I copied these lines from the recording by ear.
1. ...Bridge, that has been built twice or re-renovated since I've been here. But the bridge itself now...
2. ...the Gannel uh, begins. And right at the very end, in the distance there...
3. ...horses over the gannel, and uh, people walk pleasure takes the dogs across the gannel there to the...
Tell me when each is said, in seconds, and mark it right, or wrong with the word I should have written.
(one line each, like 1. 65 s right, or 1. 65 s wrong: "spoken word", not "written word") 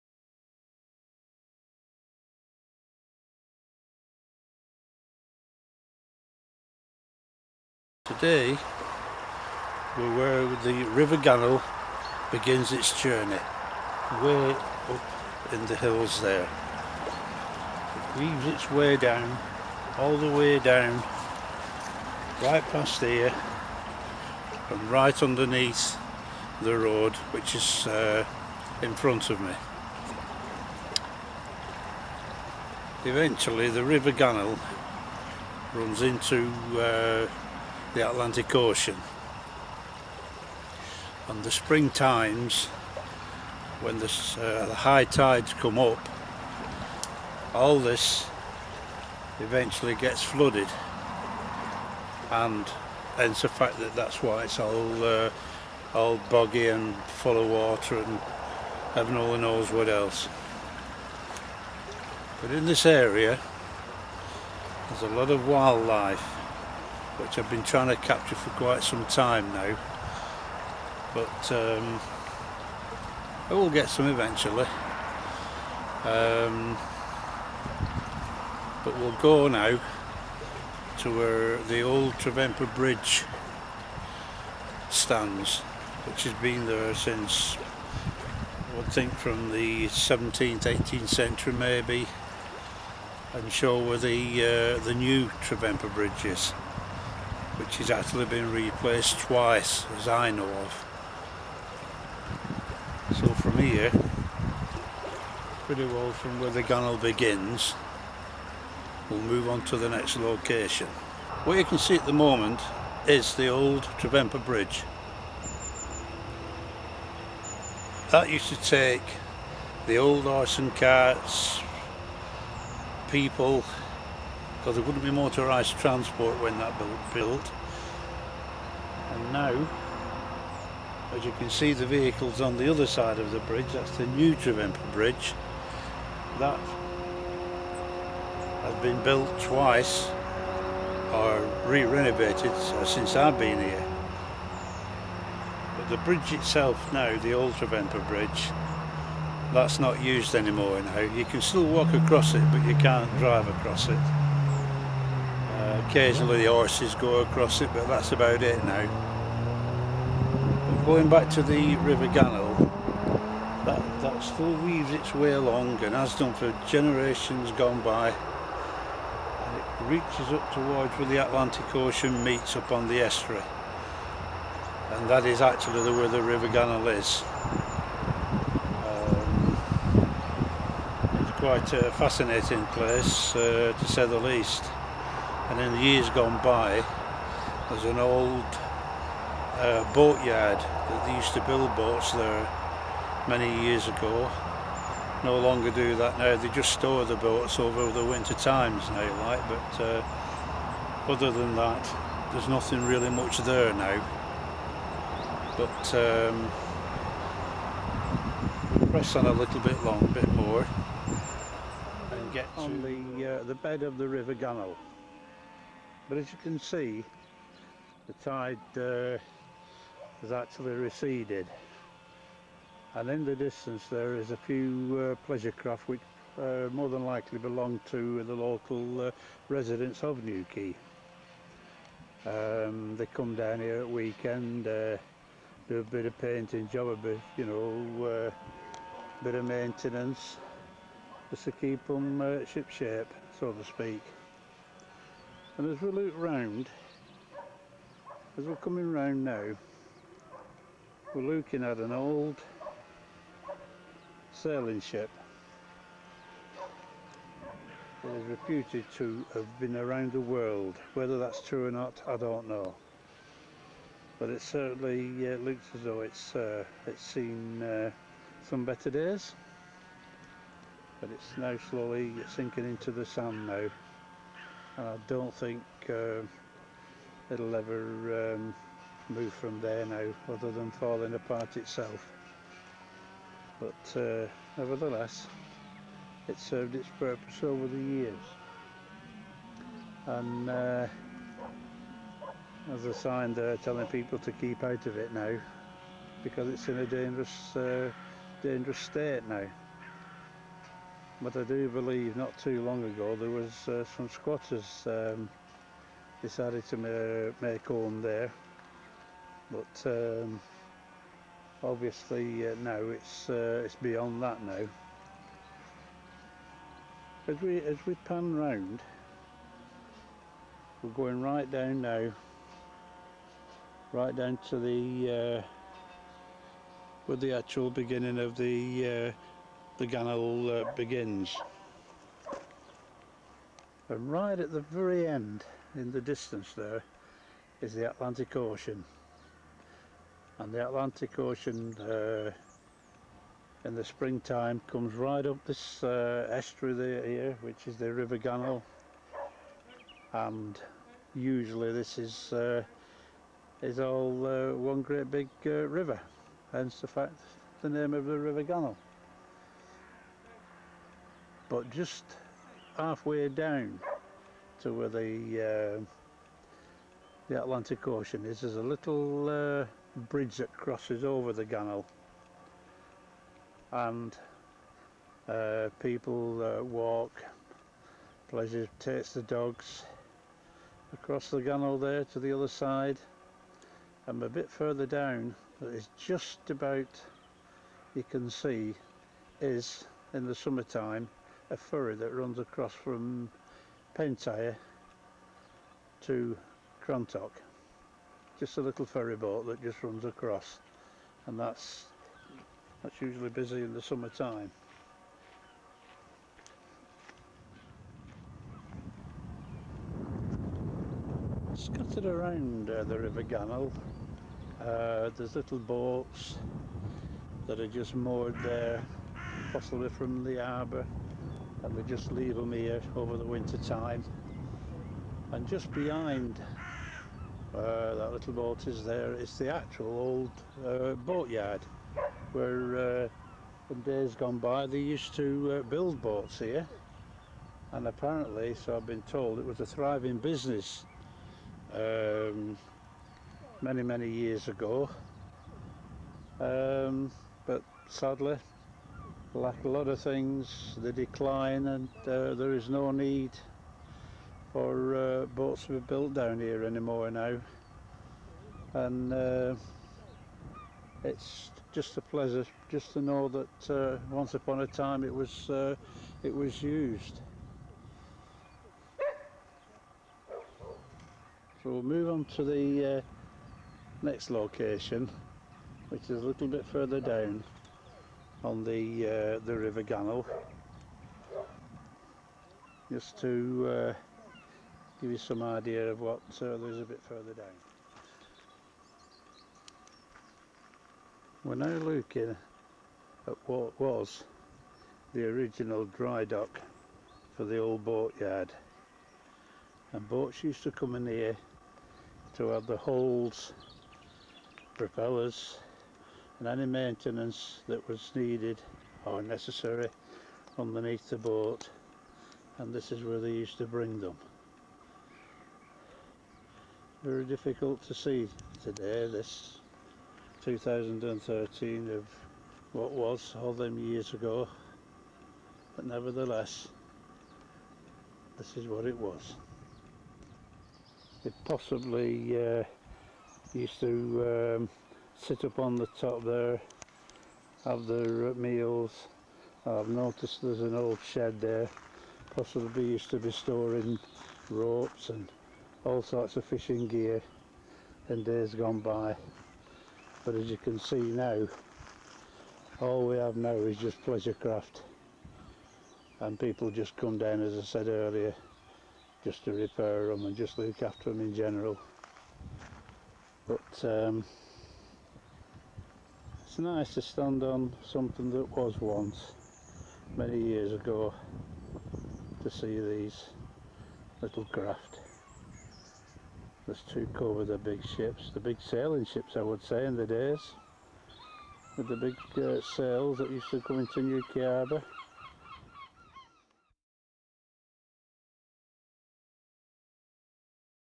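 1. 134 s right
2. 329 s right
3. 370 s wrong: "crosses", not "horses".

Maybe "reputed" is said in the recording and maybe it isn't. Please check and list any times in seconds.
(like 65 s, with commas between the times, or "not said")
258 s.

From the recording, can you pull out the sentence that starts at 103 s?
So from here, pretty well from where the gannel begins, we'll move on to the next location.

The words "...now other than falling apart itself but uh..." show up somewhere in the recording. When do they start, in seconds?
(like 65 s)
279 s.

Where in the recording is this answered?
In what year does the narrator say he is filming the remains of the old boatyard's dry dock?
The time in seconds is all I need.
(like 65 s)
520 s.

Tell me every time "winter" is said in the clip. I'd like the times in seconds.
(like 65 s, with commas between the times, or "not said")
198 s, 423 s.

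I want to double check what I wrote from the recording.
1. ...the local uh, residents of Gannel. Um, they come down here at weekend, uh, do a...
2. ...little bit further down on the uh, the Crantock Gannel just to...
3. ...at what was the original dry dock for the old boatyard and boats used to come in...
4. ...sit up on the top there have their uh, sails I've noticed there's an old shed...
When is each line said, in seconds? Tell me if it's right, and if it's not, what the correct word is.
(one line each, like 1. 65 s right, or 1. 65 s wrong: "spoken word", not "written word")
1. 228 s wrong: "Newquay", not "Gannel"
2. 476 s wrong: "River", not "Crantock"
3. 493 s right
4. 535 s wrong: "meals", not "sails".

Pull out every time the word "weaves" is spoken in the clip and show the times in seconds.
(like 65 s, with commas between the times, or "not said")
18 s, 164 s.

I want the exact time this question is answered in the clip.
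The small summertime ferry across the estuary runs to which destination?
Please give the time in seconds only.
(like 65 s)
396 s.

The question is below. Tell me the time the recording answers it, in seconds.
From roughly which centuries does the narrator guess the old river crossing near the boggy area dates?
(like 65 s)
89 s.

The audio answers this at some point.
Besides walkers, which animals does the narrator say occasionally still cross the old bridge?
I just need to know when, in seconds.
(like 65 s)
156 s.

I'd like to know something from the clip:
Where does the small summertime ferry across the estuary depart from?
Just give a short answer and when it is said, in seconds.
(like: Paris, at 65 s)
Pentire, at 393 s.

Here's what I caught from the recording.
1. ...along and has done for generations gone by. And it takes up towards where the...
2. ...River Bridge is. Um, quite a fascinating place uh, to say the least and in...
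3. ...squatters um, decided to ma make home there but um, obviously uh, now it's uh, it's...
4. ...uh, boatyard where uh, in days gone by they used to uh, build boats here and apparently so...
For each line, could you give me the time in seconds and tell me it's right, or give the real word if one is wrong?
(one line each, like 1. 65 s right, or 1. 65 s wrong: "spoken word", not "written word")
1. 165 s wrong: "reaches", not "takes"
2. 176 s wrong: "Gannel", not "Bridge"
3. 304 s right
4. 430 s right.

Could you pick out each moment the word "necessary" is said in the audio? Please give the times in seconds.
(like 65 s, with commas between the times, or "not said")
509 s.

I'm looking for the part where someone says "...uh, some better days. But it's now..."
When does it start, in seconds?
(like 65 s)
267 s.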